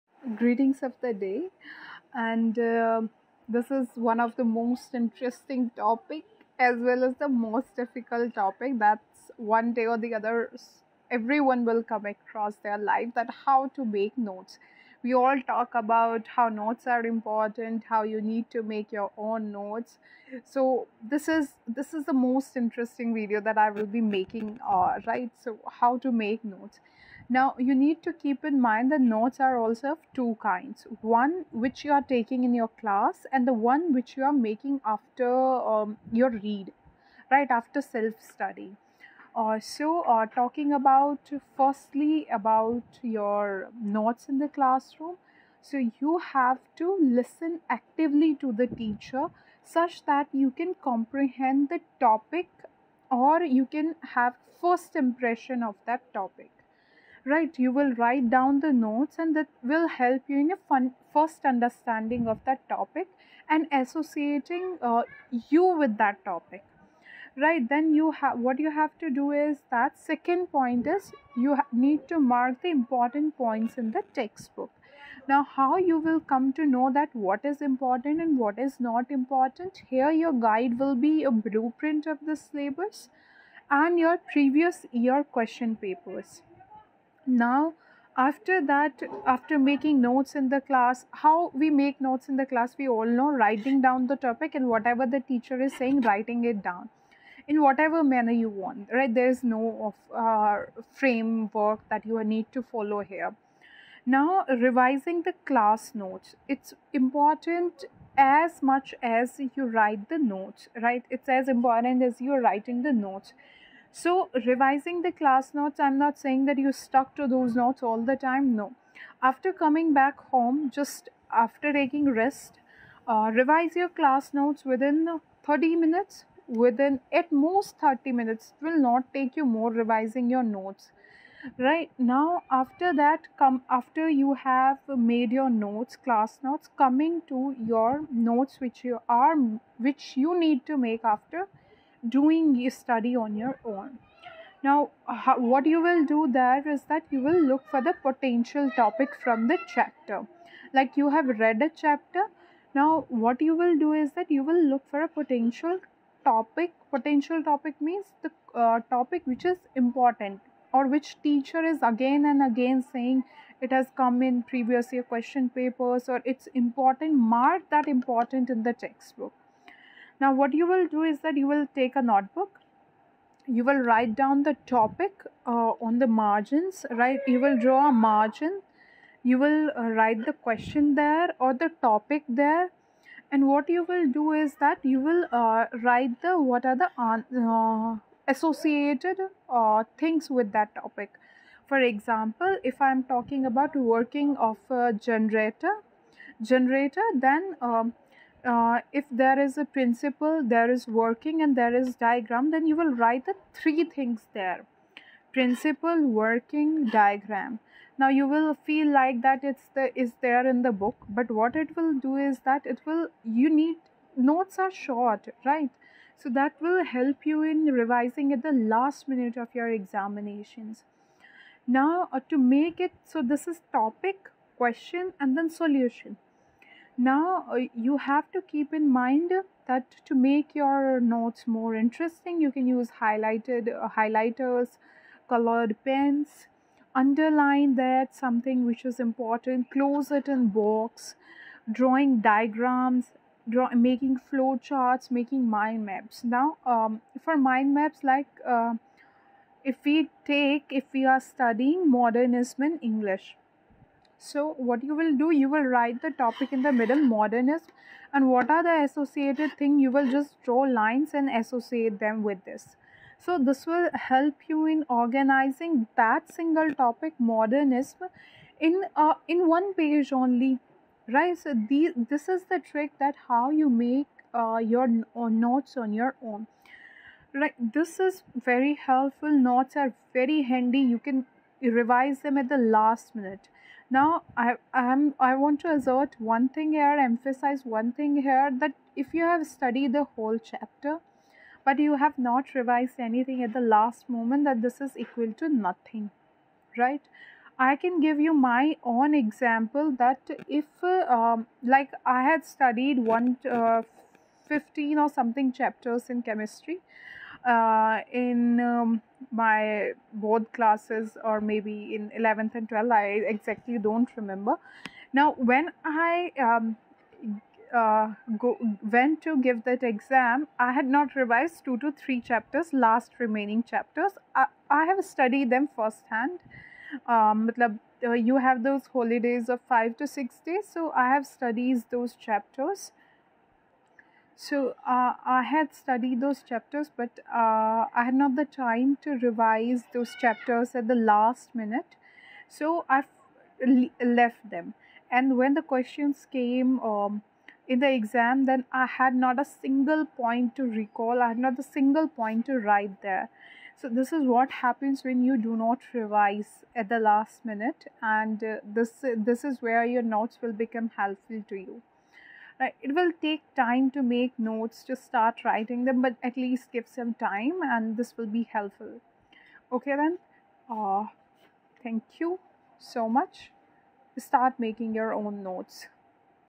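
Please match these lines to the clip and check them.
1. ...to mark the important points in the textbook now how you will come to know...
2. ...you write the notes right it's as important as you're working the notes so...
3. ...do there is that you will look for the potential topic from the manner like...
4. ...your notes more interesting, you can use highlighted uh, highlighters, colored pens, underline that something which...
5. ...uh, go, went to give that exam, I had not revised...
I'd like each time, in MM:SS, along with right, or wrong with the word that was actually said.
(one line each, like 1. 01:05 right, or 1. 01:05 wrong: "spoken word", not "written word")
1. 01:12 right
2. 01:49 wrong: "writing", not "working"
3. 02:26 wrong: "chapter", not "manner"
4. 03:50 right
5. 05:17 right.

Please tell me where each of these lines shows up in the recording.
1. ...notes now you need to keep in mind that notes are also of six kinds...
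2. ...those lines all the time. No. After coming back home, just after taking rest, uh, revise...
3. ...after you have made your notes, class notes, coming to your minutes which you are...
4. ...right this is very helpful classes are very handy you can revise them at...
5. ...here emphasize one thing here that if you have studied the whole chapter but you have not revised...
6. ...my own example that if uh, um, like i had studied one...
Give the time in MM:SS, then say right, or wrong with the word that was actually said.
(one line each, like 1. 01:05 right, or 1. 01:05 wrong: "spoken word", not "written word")
1. 00:26 wrong: "two", not "six"
2. 01:57 wrong: "notes", not "lines"
3. 02:13 wrong: "notes", not "minutes"
4. 04:37 wrong: "notes", not "classes"
5. 04:46 right
6. 04:58 right.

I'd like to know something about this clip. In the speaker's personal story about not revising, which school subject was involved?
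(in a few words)
Chemistry.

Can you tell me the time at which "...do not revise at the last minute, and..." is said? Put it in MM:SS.
05:55.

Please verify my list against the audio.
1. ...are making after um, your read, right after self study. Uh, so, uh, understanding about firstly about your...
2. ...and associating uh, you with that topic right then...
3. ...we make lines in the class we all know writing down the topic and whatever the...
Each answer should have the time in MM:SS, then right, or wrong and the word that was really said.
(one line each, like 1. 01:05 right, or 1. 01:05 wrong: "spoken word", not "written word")
1. 00:34 wrong: "talking", not "understanding"
2. 01:03 right
3. 01:31 wrong: "notes", not "lines".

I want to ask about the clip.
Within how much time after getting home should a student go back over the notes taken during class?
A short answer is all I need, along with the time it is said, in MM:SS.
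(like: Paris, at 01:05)
30 minutes, at 02:06.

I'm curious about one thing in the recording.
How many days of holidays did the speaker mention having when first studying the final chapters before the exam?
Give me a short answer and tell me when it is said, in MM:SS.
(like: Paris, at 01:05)
5 to 6 days, at 05:29.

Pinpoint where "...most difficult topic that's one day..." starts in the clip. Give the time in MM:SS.
00:07.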